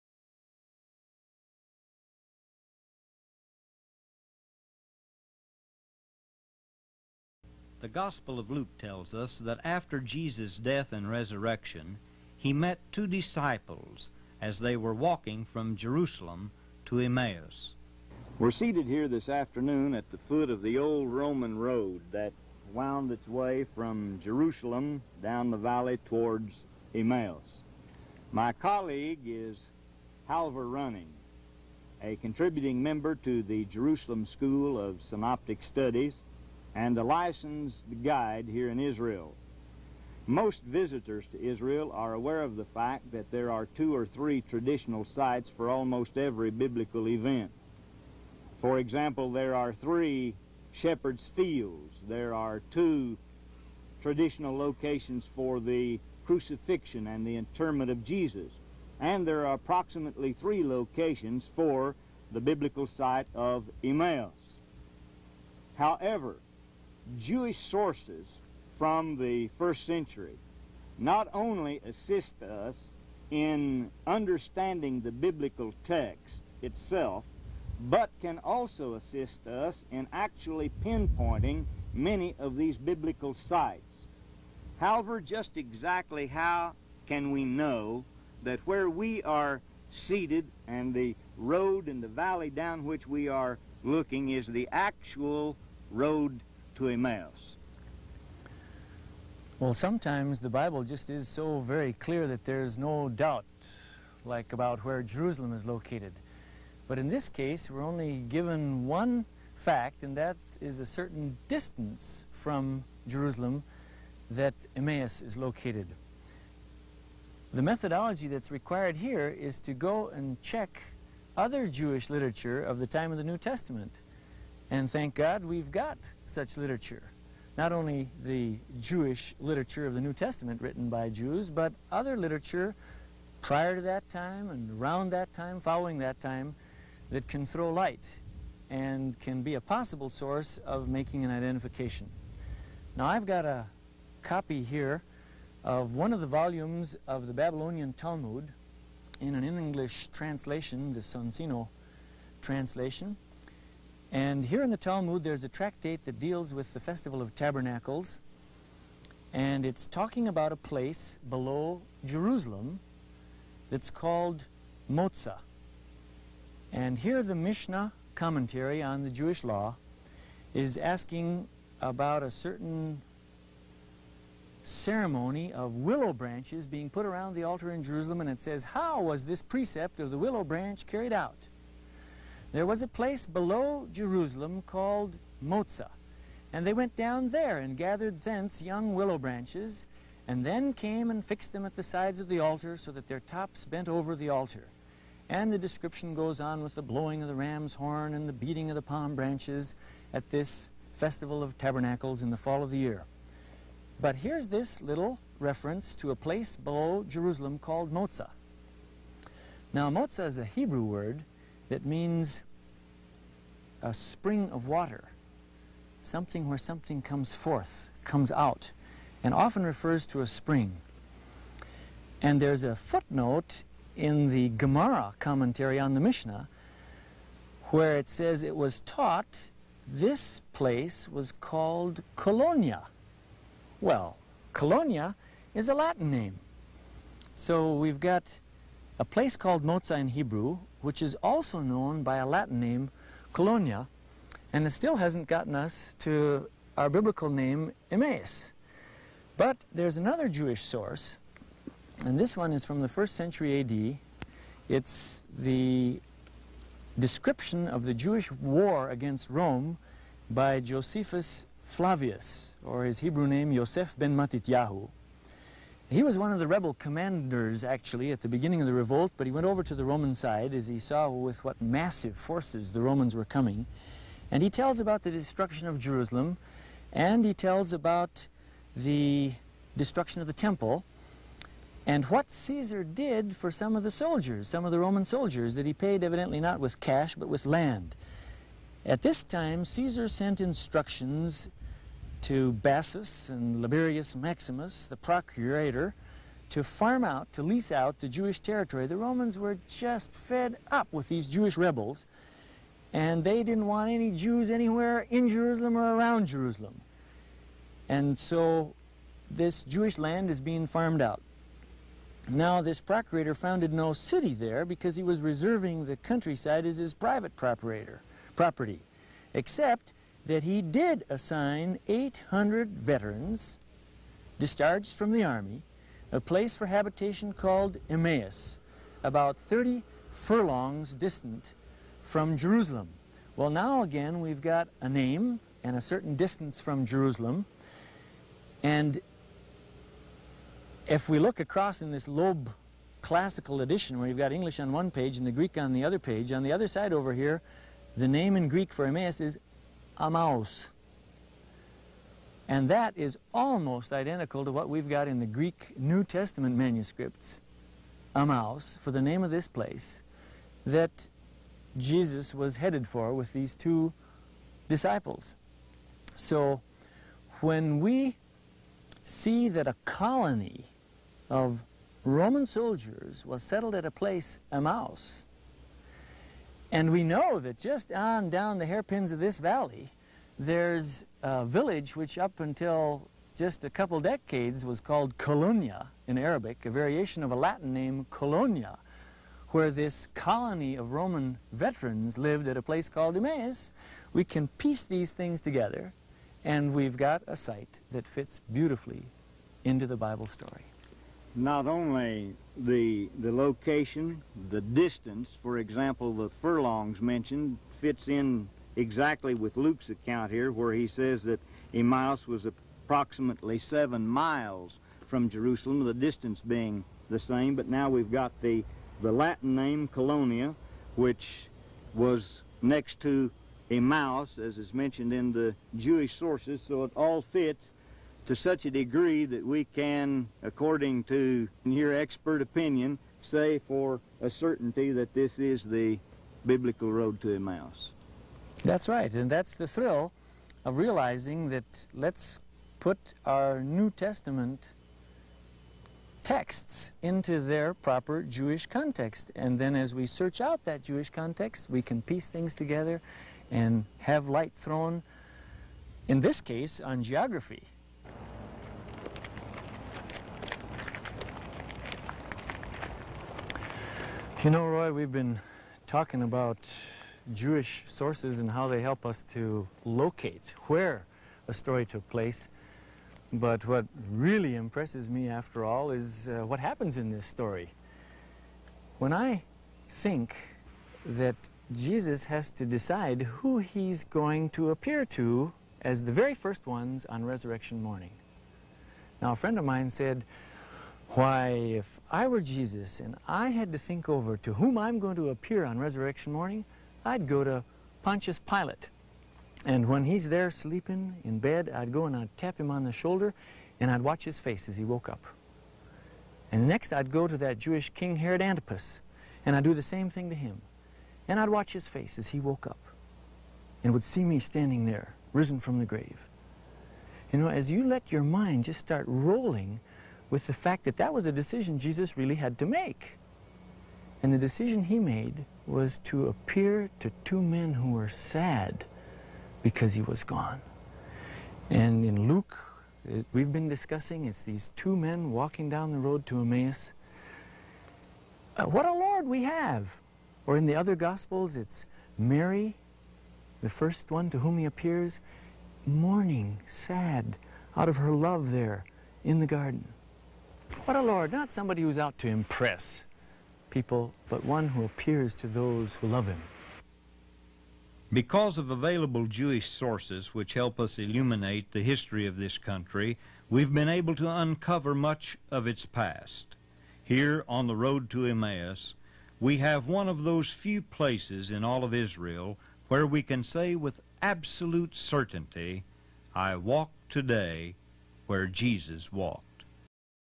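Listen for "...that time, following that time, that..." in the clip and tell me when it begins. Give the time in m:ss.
2:15.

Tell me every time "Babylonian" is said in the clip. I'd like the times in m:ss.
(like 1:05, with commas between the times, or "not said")
2:27.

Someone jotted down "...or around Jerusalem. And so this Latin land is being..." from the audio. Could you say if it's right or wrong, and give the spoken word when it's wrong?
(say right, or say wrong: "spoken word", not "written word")
wrong: "Jewish", not "Latin".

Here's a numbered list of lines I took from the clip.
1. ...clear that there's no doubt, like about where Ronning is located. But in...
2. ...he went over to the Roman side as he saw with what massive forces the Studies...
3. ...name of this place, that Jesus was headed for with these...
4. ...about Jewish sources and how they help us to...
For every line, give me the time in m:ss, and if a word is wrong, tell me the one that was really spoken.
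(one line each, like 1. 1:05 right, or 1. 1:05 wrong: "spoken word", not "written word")
1. 1:41 wrong: "Jerusalem", not "Ronning"
2. 4:29 wrong: "Romans", not "Studies"
3. 5:59 right
4. 7:46 right.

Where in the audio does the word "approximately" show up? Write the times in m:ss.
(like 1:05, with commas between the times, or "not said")
0:59, 6:52.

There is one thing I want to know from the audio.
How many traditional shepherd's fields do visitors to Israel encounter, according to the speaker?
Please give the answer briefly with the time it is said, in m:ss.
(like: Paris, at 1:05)
3, at 0:49.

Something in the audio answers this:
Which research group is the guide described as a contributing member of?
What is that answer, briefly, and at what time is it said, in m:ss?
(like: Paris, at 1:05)
Jerusalem School of Synoptic Studies, at 0:33.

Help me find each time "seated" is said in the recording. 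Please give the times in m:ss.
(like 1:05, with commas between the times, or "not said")
0:18, 1:29.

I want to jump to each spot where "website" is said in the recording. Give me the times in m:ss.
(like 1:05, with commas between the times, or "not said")
not said.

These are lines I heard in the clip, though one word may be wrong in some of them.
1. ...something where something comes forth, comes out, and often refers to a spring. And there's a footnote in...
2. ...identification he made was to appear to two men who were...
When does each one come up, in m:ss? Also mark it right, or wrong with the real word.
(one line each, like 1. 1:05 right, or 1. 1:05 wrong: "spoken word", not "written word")
1. 3:36 right
2. 8:44 wrong: "decision", not "identification".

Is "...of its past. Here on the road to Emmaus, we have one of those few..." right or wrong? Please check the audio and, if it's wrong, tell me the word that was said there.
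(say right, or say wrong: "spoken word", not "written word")
right.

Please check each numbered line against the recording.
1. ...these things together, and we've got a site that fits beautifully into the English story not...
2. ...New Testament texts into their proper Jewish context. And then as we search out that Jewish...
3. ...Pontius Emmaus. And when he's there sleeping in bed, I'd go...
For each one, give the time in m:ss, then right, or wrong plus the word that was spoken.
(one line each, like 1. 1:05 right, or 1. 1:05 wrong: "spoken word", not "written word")
1. 6:34 wrong: "Bible", not "English"
2. 7:23 right
3. 8:18 wrong: "Pilate", not "Emmaus".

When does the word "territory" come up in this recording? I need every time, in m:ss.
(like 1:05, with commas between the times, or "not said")
4:58.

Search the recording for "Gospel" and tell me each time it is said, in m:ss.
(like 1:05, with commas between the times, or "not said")
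0:07, 9:00.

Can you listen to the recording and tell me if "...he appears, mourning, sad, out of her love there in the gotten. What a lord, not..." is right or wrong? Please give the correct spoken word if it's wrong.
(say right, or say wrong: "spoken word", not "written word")
wrong: "garden", not "gotten".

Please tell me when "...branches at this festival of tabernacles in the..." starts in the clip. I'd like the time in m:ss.
3:19.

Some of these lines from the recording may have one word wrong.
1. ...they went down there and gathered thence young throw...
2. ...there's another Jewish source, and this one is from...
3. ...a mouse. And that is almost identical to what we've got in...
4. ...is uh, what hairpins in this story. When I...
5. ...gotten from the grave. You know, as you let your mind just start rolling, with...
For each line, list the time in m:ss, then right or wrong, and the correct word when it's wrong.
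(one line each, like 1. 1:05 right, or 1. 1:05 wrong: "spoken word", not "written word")
1. 3:06 wrong: "willow", not "throw"
2. 4:09 right
3. 5:50 right
4. 7:55 wrong: "happens", not "hairpins"
5. 8:35 wrong: "risen", not "gotten".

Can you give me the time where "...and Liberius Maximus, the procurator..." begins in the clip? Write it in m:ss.
4:53.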